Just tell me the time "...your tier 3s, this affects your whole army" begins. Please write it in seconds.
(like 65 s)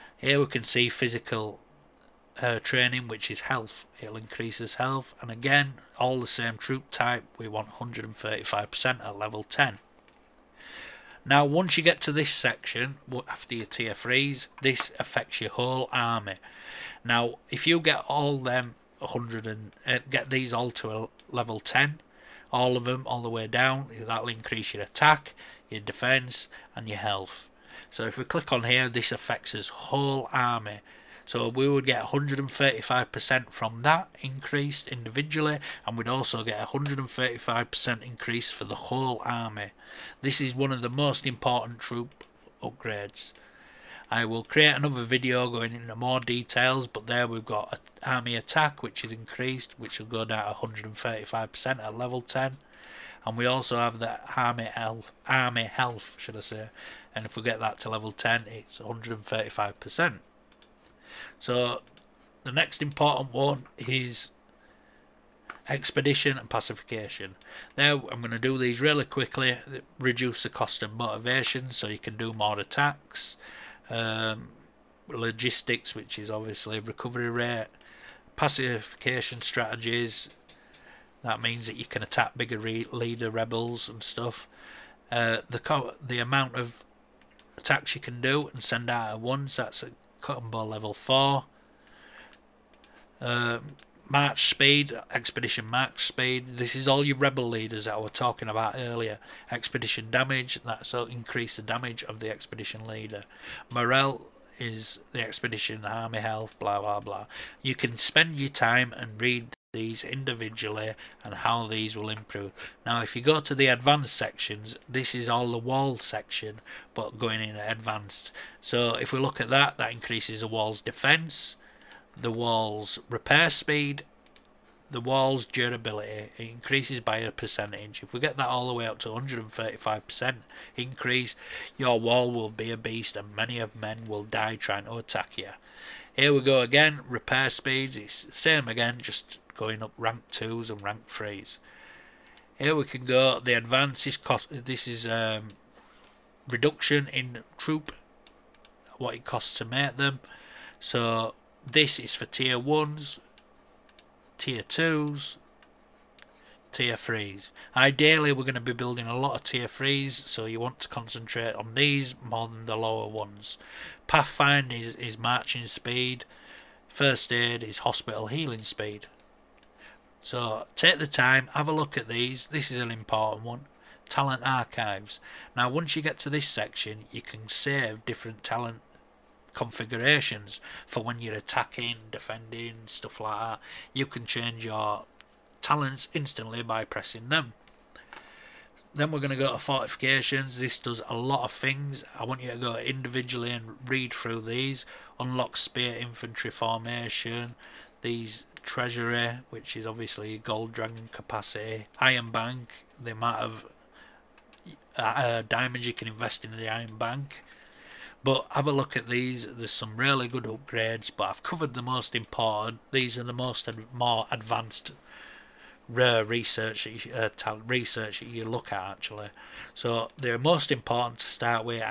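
13 s.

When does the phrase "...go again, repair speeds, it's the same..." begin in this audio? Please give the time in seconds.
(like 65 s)
136 s.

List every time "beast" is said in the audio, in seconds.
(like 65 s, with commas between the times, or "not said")
132 s.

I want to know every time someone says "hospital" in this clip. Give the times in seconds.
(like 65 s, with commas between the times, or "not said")
167 s.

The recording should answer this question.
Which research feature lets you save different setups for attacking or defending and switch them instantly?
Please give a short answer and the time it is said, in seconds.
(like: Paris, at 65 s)
Talent archives, at 174 s.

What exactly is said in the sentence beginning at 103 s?
Morale is the expedition, army health, blah blah blah.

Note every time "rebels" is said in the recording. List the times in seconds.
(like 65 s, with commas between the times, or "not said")
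83 s, 97 s.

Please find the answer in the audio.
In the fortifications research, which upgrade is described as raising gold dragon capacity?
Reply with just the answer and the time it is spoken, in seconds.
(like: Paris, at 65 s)
Treasury, at 198 s.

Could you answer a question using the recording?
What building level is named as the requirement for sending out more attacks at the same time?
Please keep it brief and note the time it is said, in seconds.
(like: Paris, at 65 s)
Cotton Ball level 4, at 90 s.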